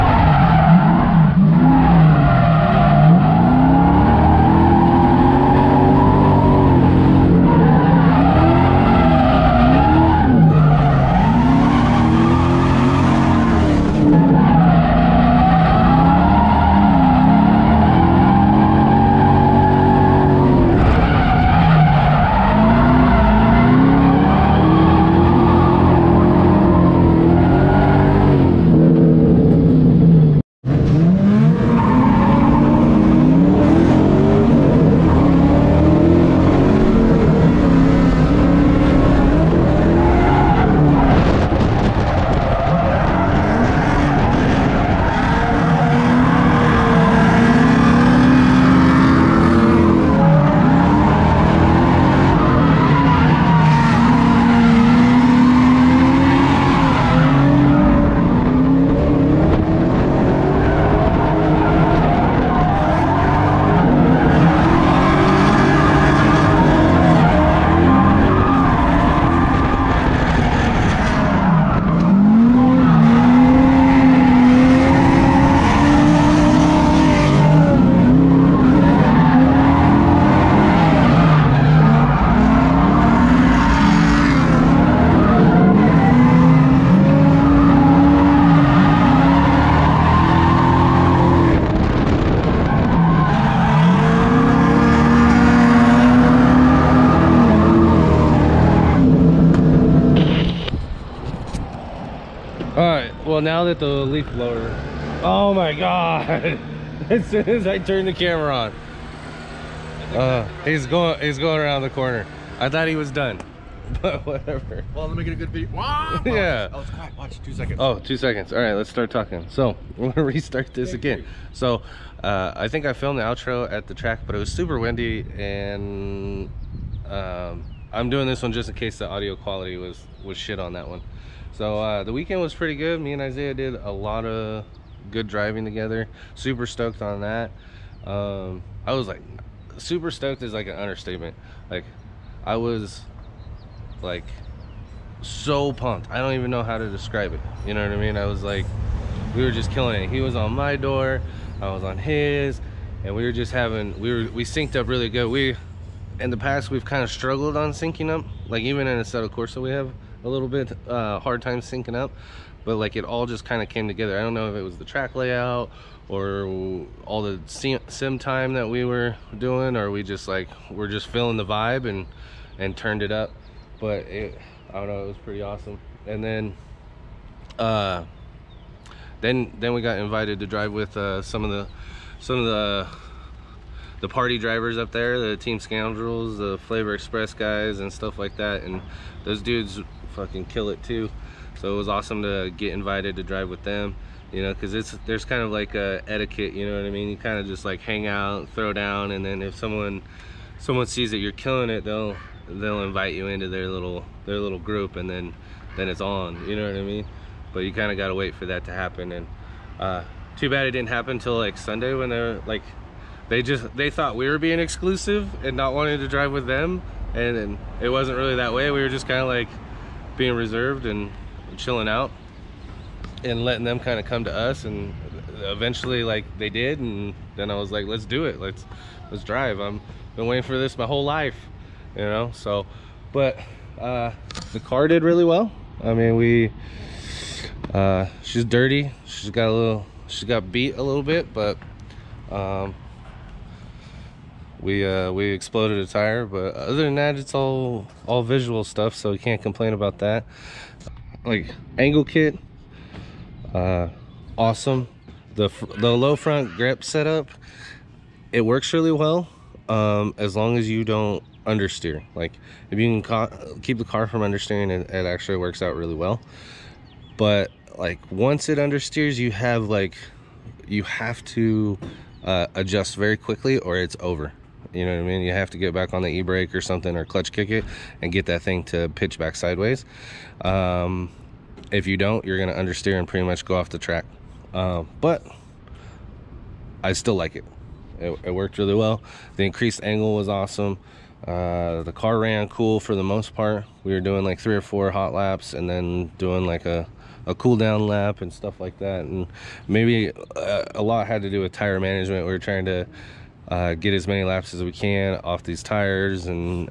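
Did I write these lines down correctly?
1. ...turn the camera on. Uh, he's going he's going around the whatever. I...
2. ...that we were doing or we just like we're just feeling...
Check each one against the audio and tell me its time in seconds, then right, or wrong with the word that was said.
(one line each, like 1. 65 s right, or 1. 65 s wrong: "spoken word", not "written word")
1. 107 s wrong: "corner", not "whatever"
2. 168 s right.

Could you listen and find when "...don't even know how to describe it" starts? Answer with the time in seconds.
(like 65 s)
146 s.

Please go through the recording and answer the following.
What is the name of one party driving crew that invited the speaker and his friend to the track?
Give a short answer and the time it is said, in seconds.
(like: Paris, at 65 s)
Team Scoundrels, at 185 s.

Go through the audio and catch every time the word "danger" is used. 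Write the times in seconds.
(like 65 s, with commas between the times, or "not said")
not said.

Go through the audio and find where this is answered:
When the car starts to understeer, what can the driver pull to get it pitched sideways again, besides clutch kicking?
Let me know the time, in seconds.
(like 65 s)
276 s.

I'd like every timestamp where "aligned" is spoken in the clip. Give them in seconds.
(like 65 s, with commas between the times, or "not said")
not said.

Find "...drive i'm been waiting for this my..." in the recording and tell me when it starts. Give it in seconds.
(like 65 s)
229 s.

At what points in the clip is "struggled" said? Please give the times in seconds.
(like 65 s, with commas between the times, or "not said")
157 s.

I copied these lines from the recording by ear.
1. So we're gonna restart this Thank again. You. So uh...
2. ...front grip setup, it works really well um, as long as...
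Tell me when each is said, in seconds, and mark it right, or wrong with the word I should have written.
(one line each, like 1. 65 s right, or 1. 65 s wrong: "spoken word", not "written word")
1. 119 s right
2. 256 s right.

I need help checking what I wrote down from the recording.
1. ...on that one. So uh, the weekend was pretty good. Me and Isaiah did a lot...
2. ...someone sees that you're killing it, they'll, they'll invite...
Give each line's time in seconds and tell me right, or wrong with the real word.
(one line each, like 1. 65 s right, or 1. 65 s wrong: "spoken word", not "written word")
1. 130 s right
2. 200 s right.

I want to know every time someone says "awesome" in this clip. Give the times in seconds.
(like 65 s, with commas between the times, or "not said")
175 s, 191 s, 254 s, 290 s.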